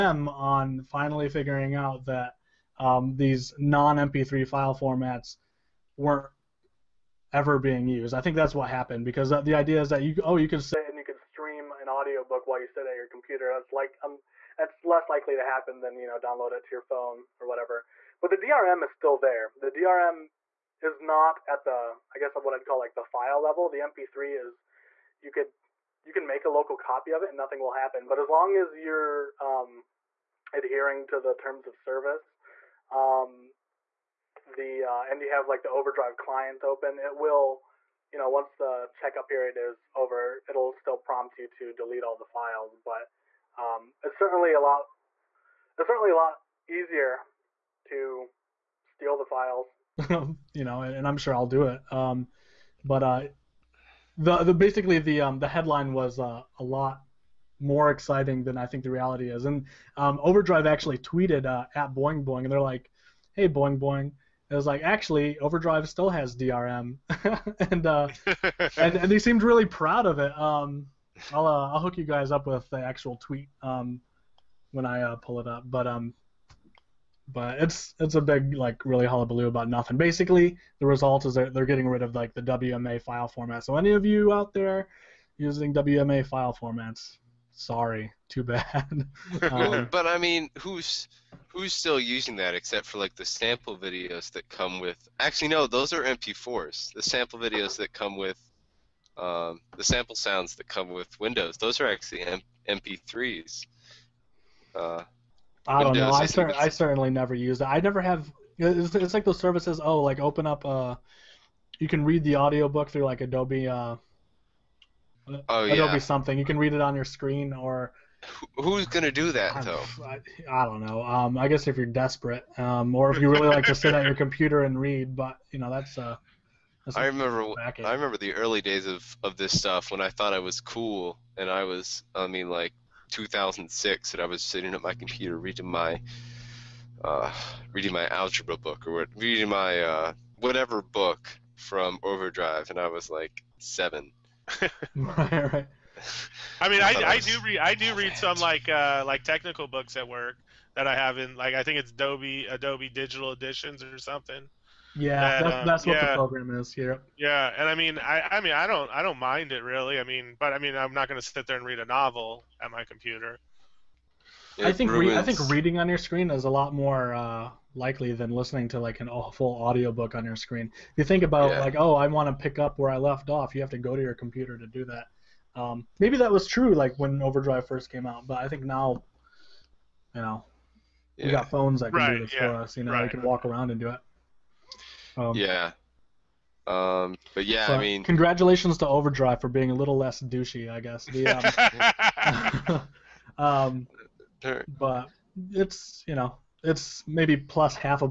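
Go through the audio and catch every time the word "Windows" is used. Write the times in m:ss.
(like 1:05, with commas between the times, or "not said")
1:41, 1:45.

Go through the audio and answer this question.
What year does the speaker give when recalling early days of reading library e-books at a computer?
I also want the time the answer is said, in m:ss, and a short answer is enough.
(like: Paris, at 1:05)
2006, at 2:13.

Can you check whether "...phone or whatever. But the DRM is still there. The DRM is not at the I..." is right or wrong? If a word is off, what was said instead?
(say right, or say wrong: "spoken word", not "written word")
right.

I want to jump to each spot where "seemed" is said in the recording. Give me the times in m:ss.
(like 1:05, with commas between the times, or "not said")
1:09.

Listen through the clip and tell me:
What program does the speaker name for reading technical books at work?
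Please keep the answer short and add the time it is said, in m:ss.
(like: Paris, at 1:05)
Adobe Digital Editions, at 2:32.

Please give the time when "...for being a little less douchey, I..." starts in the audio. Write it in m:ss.
3:09.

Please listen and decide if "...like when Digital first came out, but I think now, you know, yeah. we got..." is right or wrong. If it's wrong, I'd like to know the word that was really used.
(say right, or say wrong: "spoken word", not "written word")
wrong: "Overdrive", not "Digital".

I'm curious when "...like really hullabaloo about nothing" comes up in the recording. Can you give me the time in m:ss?
1:18.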